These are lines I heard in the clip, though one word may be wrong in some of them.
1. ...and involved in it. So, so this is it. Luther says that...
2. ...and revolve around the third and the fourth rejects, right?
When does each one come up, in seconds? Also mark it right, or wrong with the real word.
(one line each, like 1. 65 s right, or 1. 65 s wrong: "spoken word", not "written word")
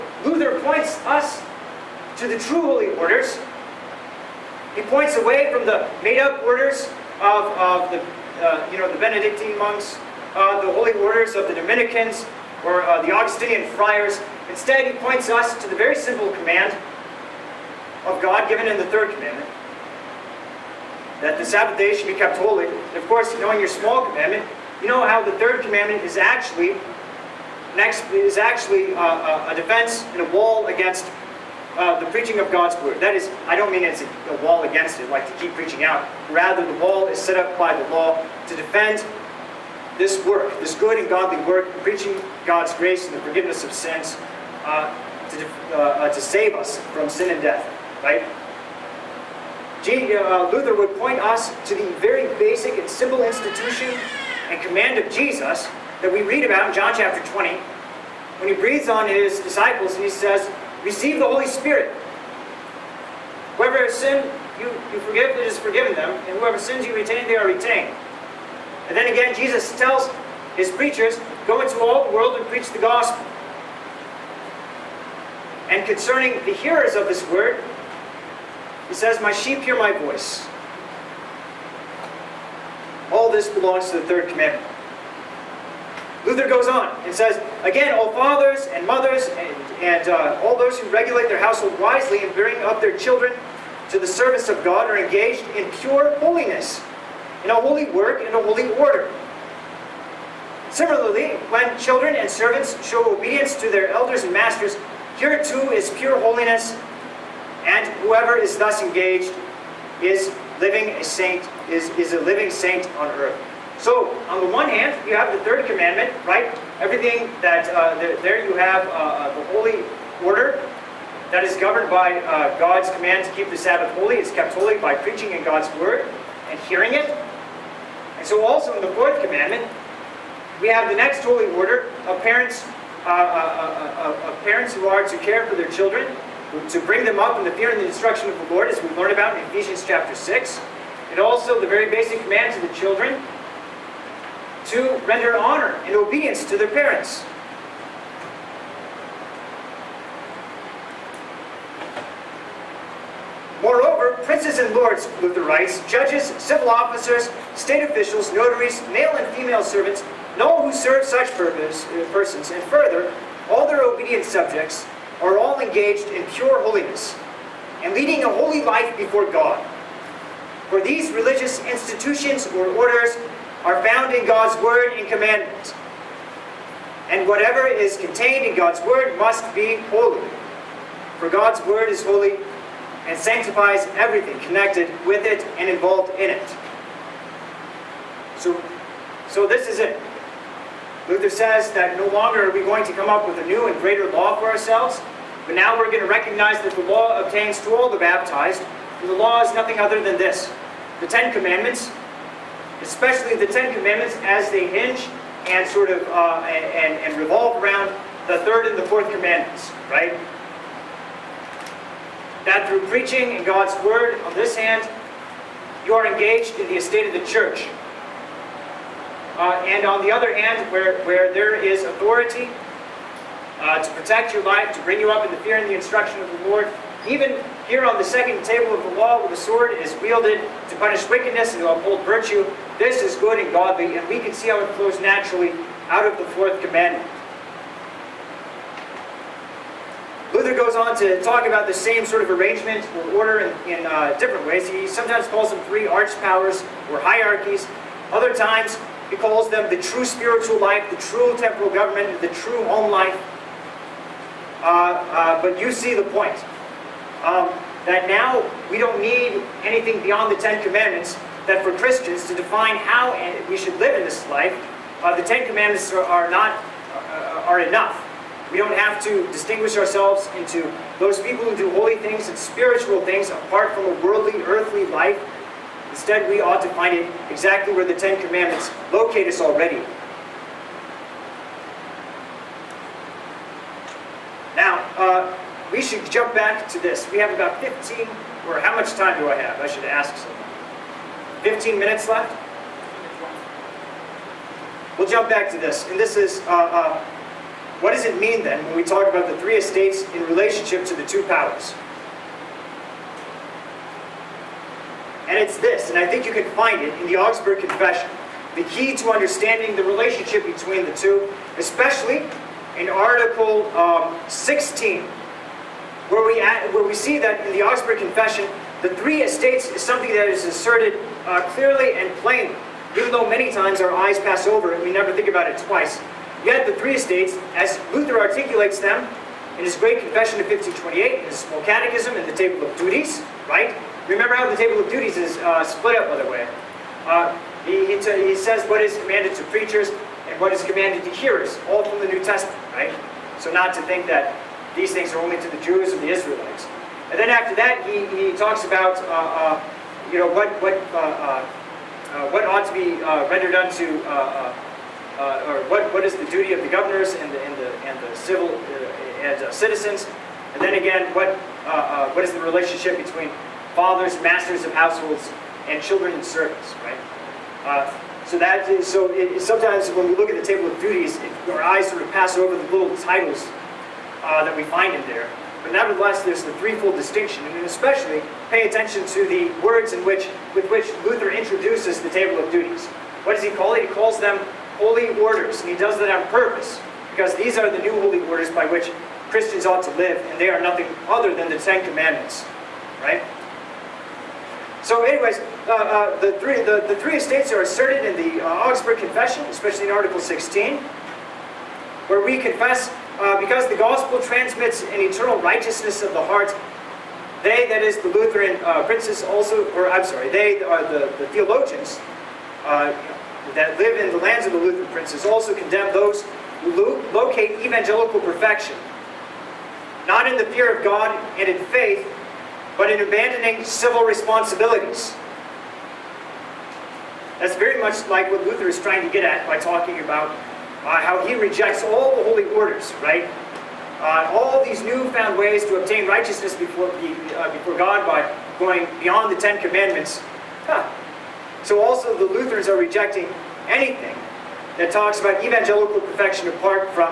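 1. 185 s right
2. 207 s wrong: "commandments", not "rejects".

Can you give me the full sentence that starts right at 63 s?
Whoever has sinned, you, you forgive, it is forgiven them, and whoever sins you retain, they are retained.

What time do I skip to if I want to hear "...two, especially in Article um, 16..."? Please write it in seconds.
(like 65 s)
310 s.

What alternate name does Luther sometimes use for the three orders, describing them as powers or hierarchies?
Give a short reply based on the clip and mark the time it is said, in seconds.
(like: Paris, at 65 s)
Three arch powers, at 245 s.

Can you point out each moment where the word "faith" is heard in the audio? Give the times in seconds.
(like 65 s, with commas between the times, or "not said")
421 s.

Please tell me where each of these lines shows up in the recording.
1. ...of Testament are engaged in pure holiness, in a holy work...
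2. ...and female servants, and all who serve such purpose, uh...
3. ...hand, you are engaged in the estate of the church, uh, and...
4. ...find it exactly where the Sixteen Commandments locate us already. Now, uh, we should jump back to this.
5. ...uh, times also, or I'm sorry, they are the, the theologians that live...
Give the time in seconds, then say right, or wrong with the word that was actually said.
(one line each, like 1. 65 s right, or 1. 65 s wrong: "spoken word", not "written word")
1. 94 s wrong: "God", not "Testament"
2. 159 s right
3. 214 s right
4. 276 s wrong: "Ten", not "Sixteen"
5. 408 s wrong: "princes", not "times".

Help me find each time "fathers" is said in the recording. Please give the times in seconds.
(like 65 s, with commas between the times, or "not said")
88 s, 363 s.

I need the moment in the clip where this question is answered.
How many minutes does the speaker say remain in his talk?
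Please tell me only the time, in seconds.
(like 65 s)
291 s.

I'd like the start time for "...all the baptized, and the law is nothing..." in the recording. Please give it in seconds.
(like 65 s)
197 s.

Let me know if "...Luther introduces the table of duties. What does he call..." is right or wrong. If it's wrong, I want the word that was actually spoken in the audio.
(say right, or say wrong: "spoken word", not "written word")
right.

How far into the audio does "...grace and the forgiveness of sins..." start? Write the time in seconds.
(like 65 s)
42 s.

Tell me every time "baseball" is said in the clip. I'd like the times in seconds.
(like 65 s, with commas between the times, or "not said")
not said.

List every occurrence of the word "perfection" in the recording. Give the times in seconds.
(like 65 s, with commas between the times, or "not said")
418 s, 446 s.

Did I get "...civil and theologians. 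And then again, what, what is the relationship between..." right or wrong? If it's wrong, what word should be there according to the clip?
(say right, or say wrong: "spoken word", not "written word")
wrong: "citizens", not "theologians".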